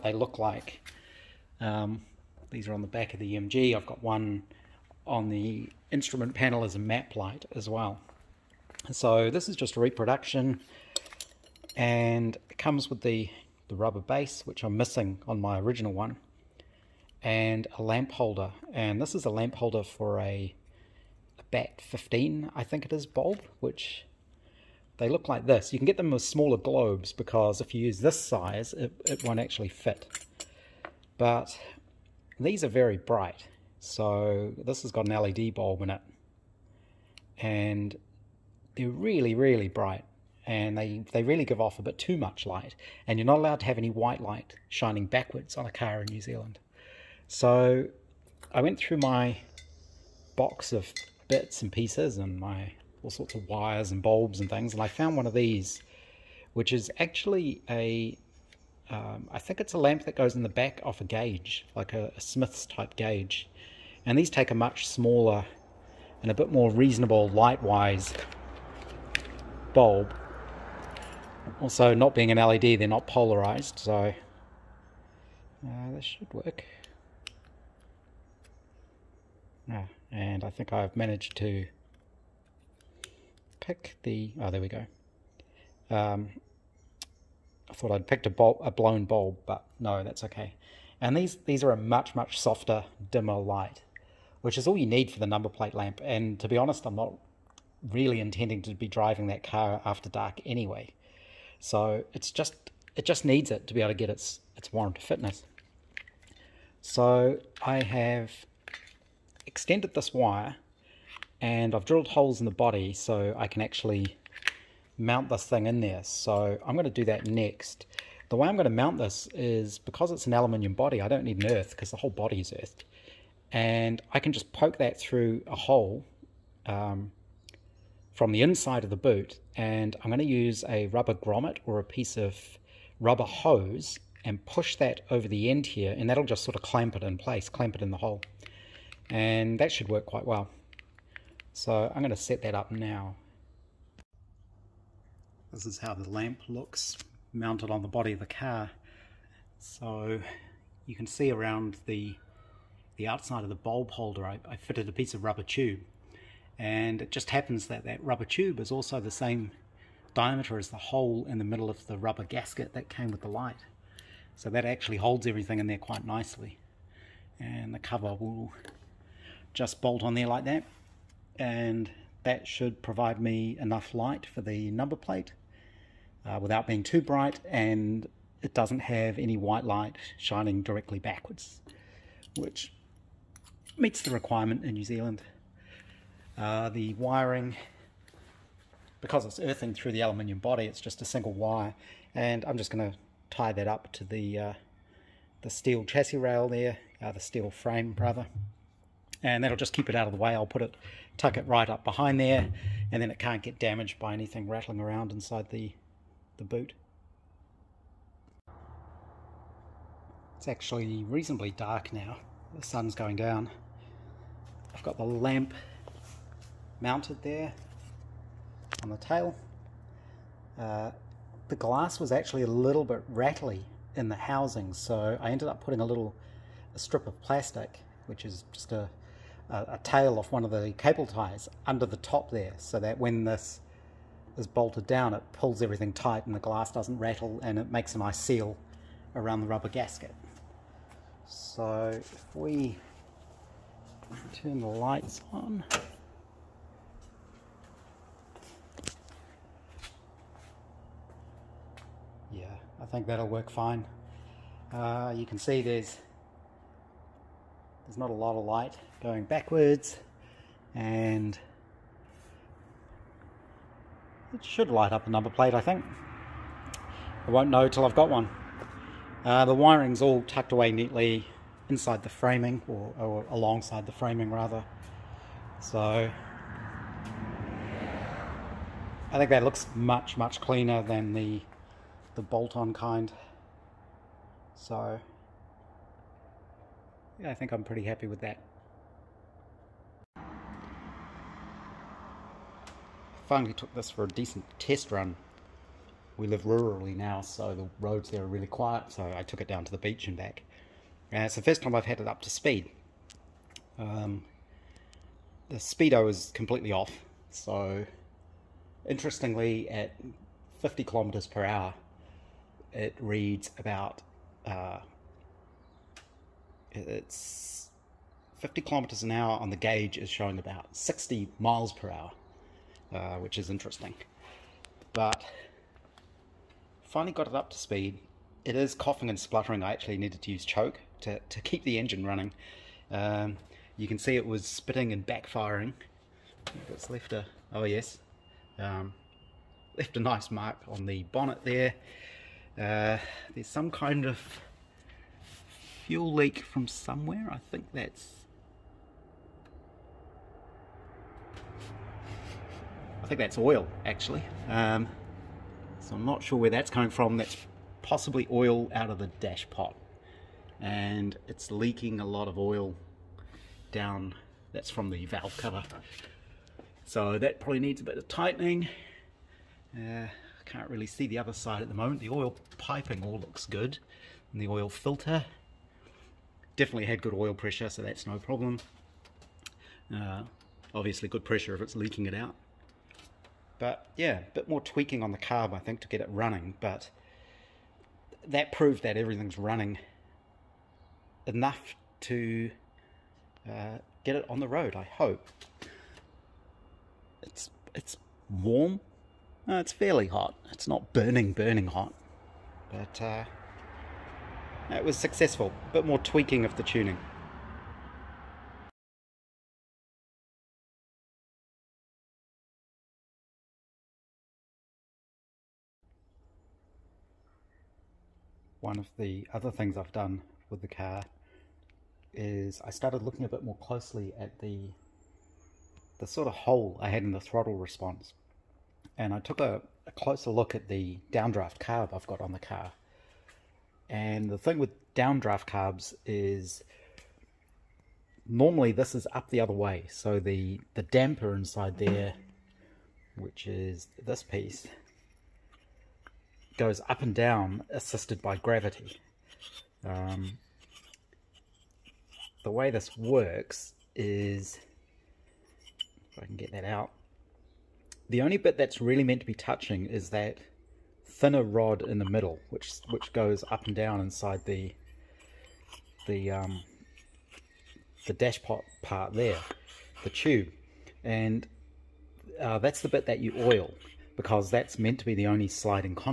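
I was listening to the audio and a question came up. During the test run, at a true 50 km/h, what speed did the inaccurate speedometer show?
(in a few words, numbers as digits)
60 miles per hour.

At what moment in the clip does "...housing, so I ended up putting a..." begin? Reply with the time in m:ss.
3:44.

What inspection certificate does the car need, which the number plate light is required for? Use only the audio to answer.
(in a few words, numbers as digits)
warrant of fitness.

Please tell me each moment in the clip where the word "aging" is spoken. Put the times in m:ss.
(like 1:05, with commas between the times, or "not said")
not said.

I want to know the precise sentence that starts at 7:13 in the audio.
And the thing with downdraft carbs is normally this is up the other way.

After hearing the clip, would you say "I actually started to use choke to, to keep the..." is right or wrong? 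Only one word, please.
wrong.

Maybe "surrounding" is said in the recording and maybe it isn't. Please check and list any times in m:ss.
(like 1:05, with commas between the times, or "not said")
not said.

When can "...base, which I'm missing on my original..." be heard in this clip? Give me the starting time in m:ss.
0:14.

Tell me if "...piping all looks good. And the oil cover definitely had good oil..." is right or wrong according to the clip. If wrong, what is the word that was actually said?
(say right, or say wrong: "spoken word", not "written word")
wrong: "filter", not "cover".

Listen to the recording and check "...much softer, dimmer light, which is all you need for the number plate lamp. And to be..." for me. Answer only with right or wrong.
right.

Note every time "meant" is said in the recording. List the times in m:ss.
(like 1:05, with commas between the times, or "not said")
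7:39, 7:54.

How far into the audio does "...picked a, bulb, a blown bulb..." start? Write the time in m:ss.
1:28.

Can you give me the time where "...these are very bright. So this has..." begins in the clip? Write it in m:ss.
0:32.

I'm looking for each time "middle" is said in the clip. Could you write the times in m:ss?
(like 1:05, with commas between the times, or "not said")
2:41, 7:42.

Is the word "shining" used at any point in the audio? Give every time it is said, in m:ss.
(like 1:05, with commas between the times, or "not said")
0:44, 3:00.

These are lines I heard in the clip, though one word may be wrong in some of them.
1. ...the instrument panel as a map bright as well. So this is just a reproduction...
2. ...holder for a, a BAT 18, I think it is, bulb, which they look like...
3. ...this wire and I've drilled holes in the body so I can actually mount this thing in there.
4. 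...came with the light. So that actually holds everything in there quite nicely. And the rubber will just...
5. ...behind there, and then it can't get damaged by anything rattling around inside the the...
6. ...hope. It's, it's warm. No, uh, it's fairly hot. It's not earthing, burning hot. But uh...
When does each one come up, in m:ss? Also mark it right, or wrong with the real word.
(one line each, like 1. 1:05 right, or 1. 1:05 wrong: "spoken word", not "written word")
1. 0:05 wrong: "light", not "bright"
2. 0:19 wrong: "15", not "18"
3. 1:49 right
4. 2:42 wrong: "cover", not "rubber"
5. 3:21 right
6. 6:34 wrong: "burning", not "earthing".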